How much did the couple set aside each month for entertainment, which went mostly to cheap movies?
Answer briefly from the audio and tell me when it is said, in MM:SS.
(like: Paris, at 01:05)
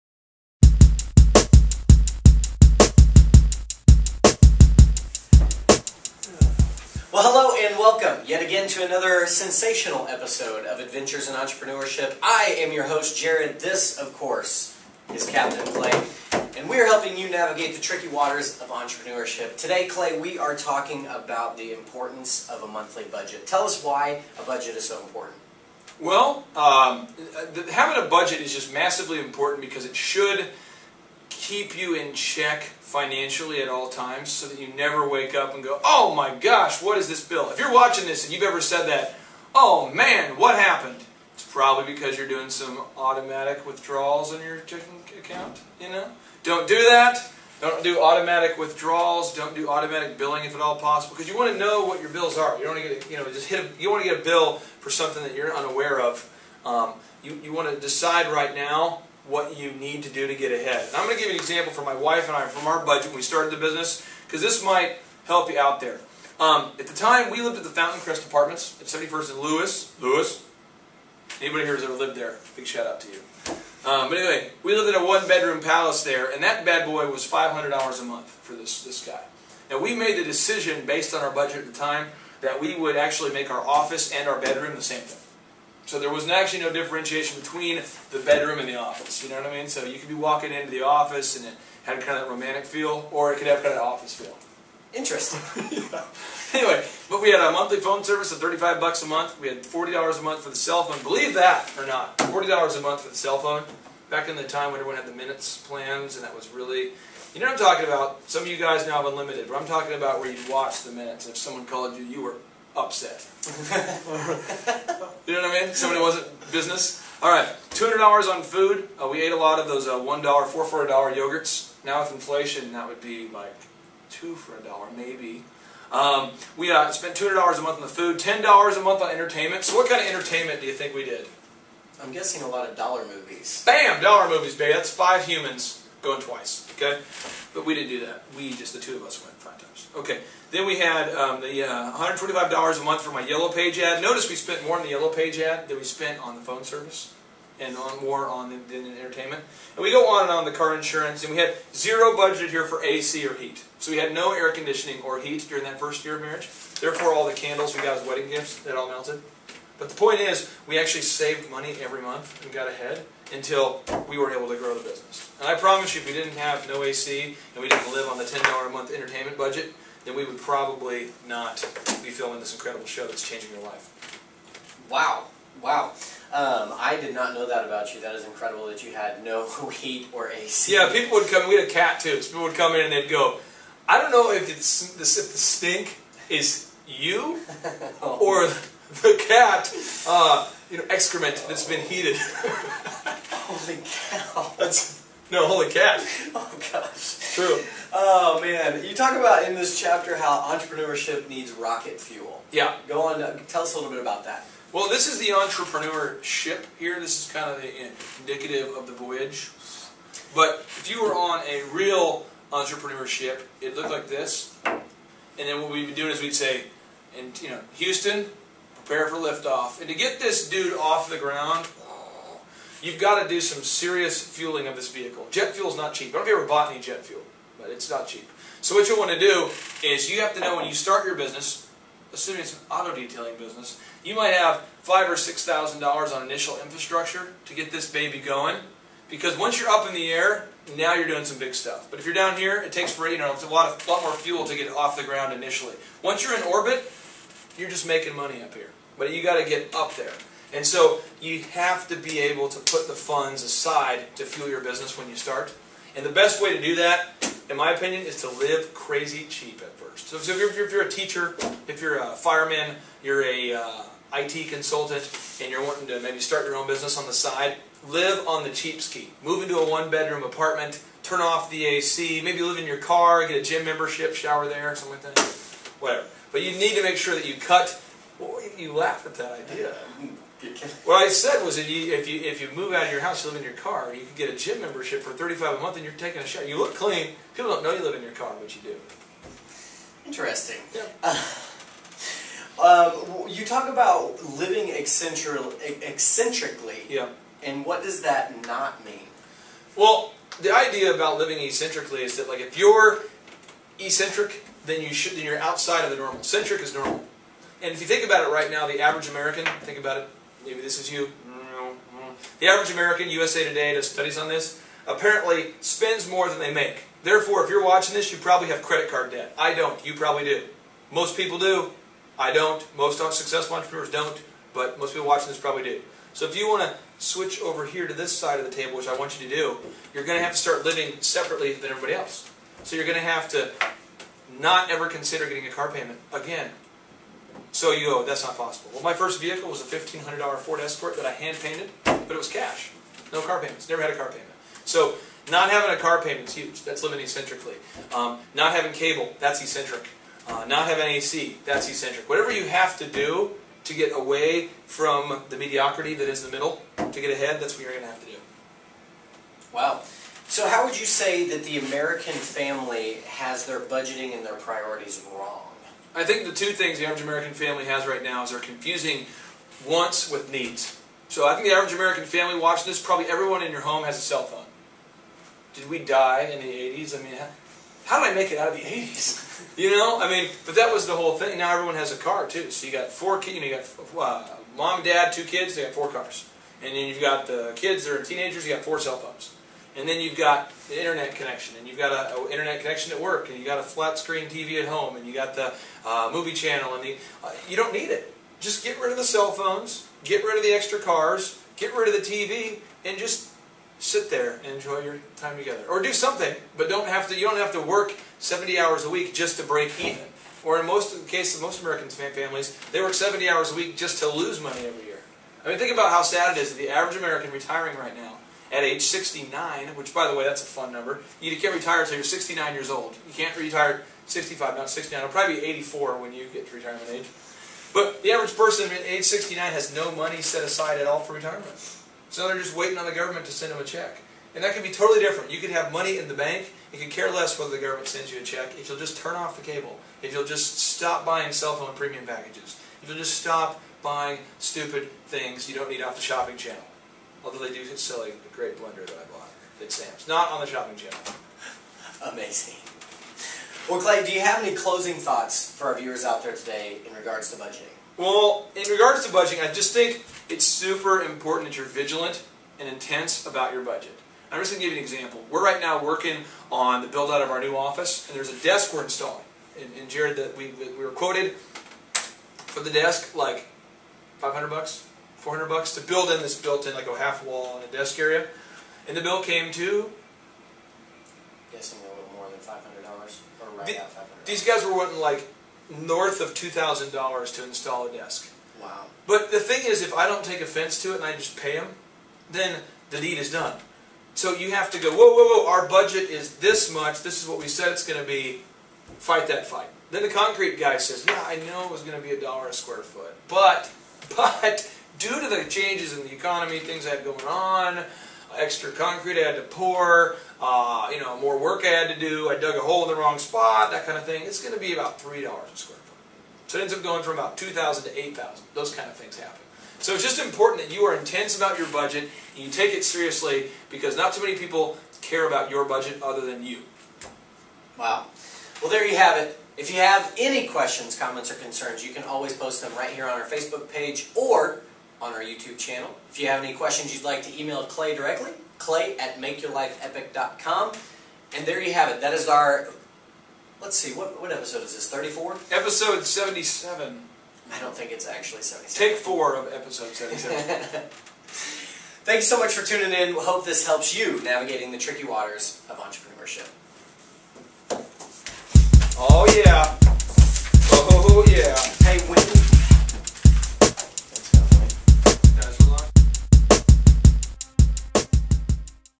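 $10, at 02:08.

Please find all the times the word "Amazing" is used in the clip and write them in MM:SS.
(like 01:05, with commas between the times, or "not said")
07:32.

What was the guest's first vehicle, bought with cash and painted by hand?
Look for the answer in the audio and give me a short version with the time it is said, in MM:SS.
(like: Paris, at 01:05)
Ford Escort, at 05:40.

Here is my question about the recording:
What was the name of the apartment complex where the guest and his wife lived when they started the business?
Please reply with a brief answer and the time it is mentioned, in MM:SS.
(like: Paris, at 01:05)
Fountain Crest Apartments, at 01:07.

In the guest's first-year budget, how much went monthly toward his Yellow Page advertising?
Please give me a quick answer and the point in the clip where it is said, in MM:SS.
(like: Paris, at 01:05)
$125, at 02:21.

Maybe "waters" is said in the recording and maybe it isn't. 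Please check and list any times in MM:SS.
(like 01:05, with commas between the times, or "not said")
00:18, 09:15.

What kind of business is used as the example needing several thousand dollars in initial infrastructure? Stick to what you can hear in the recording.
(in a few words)
auto detailing.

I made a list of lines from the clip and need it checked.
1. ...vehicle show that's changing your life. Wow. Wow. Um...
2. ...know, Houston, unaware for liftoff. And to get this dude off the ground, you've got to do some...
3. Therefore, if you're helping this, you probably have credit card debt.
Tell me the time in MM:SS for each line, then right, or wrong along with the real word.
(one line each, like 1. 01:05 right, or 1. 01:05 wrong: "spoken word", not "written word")
1. 02:52 wrong: "incredible", not "vehicle"
2. 03:37 wrong: "prepare", not "unaware"
3. 05:17 wrong: "watching", not "helping".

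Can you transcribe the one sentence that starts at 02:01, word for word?
Now with inflation, that would be like 2 for a dollar, maybe.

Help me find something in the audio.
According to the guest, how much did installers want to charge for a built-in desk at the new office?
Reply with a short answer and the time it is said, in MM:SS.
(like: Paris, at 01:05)
$2,000, at 08:06.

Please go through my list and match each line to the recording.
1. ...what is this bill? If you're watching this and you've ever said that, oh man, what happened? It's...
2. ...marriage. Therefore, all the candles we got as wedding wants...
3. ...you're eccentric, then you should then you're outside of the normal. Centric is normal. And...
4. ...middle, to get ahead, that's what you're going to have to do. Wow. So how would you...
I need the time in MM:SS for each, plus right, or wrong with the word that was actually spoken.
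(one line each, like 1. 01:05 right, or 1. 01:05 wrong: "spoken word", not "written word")
1. 00:36 right
2. 02:36 wrong: "gifts", not "wants"
3. 05:02 right
4. 05:56 right.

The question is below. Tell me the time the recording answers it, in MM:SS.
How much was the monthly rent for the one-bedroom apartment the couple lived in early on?
01:17.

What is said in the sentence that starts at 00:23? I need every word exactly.
Tell us why a budget is so important.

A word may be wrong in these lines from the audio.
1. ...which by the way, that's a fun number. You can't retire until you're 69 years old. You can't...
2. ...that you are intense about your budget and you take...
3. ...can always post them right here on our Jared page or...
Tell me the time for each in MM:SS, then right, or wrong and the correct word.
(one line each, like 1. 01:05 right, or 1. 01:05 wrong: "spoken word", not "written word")
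1. 06:59 right
2. 08:40 right
3. 08:51 wrong: "Facebook", not "Jared".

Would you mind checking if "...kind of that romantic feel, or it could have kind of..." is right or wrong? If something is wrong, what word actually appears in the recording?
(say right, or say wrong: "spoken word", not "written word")
right.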